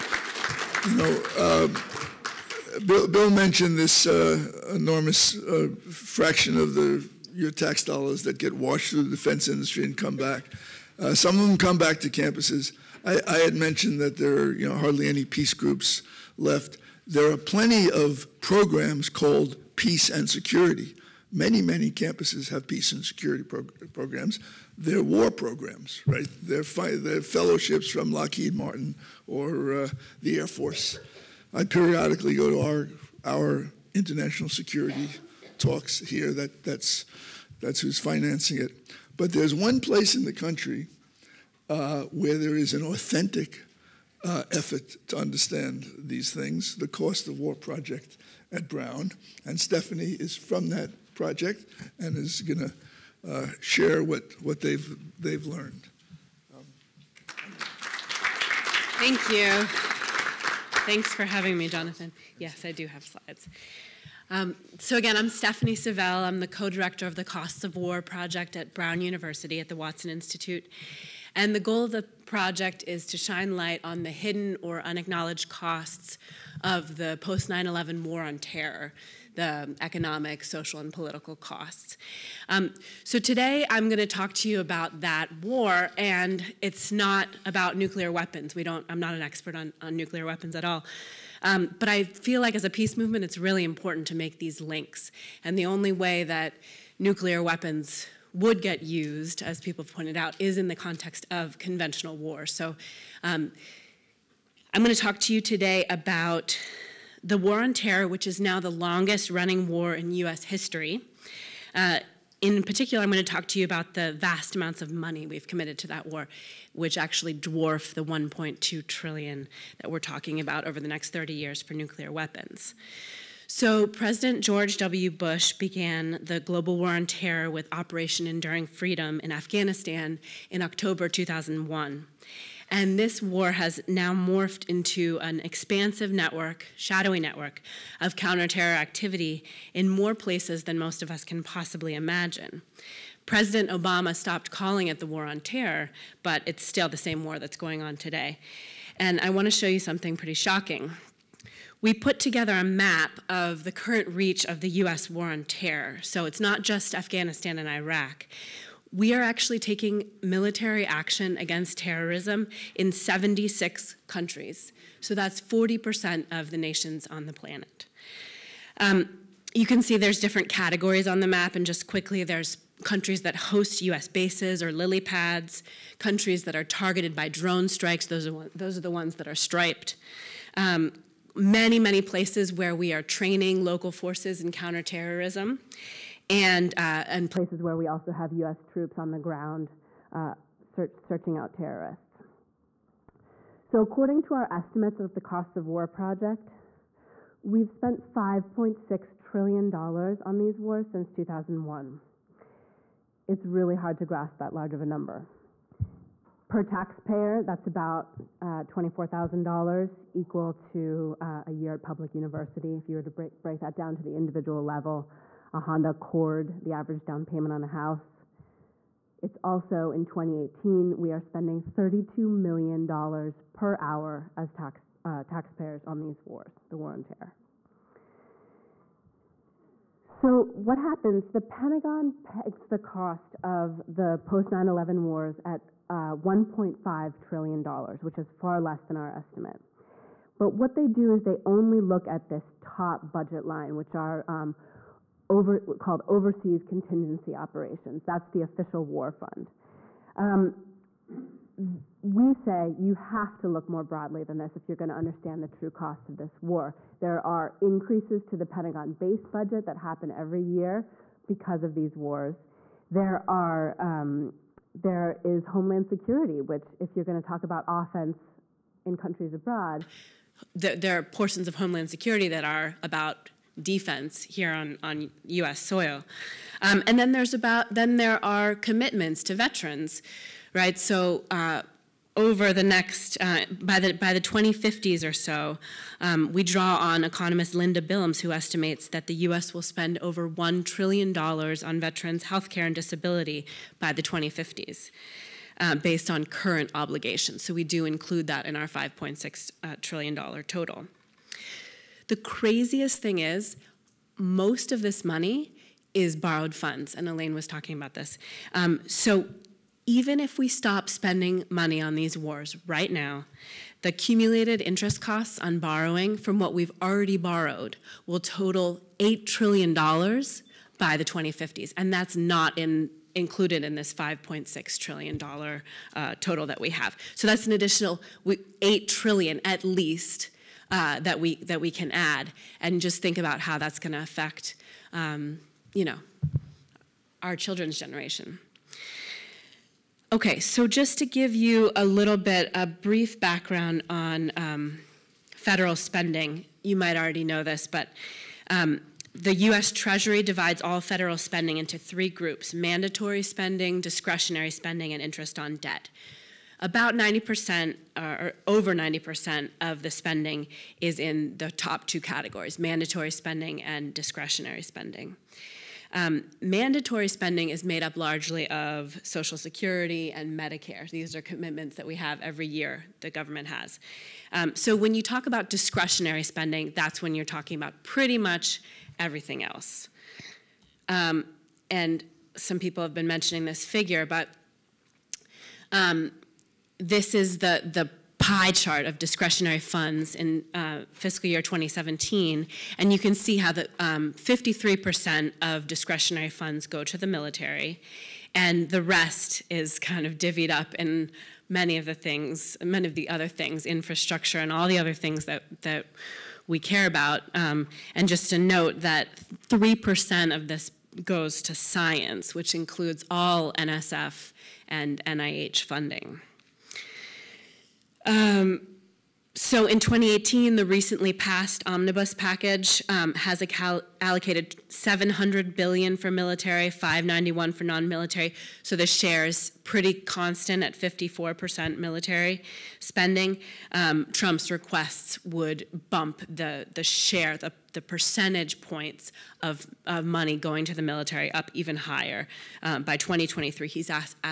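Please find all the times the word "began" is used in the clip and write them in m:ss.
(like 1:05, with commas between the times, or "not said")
2:05.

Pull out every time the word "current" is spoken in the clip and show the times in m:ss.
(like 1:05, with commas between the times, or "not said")
2:33, 4:56.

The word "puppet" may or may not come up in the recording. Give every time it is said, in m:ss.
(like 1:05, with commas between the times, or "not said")
not said.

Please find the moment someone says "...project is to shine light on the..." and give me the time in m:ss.
1:12.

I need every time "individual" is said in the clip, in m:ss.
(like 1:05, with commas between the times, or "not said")
3:34.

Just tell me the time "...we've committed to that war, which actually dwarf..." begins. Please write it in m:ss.
1:55.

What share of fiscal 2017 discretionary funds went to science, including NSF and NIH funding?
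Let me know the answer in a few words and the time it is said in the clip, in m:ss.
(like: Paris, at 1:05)
3%, at 6:49.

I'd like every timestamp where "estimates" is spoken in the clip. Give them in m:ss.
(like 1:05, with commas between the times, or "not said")
3:14, 3:59, 4:48.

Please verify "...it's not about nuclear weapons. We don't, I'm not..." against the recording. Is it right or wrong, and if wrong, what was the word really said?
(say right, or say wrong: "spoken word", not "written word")
right.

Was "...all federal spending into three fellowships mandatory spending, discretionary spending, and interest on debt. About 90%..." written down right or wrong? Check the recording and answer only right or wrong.
wrong.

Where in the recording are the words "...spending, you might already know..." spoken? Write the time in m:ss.
5:45.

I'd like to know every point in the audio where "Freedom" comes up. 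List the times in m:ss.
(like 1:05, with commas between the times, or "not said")
2:08.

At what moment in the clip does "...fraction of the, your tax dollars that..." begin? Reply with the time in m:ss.
0:05.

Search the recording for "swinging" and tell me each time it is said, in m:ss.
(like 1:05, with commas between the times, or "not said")
not said.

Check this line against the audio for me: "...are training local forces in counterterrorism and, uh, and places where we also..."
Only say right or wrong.
right.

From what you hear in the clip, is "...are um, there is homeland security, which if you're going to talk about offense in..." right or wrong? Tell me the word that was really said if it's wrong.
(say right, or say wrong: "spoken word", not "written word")
right.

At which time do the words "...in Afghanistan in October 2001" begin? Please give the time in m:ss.
2:09.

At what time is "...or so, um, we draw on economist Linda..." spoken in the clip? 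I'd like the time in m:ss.
4:45.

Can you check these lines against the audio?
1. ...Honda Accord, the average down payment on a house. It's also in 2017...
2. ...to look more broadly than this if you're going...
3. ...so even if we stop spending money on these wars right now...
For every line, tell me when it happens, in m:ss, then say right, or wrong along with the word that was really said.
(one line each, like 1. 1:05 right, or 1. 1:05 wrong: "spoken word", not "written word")
1. 3:35 wrong: "2018", not "2017"
2. 4:13 right
3. 5:08 right.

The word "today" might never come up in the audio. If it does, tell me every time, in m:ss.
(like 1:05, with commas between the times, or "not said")
1:23, 1:45, 2:27.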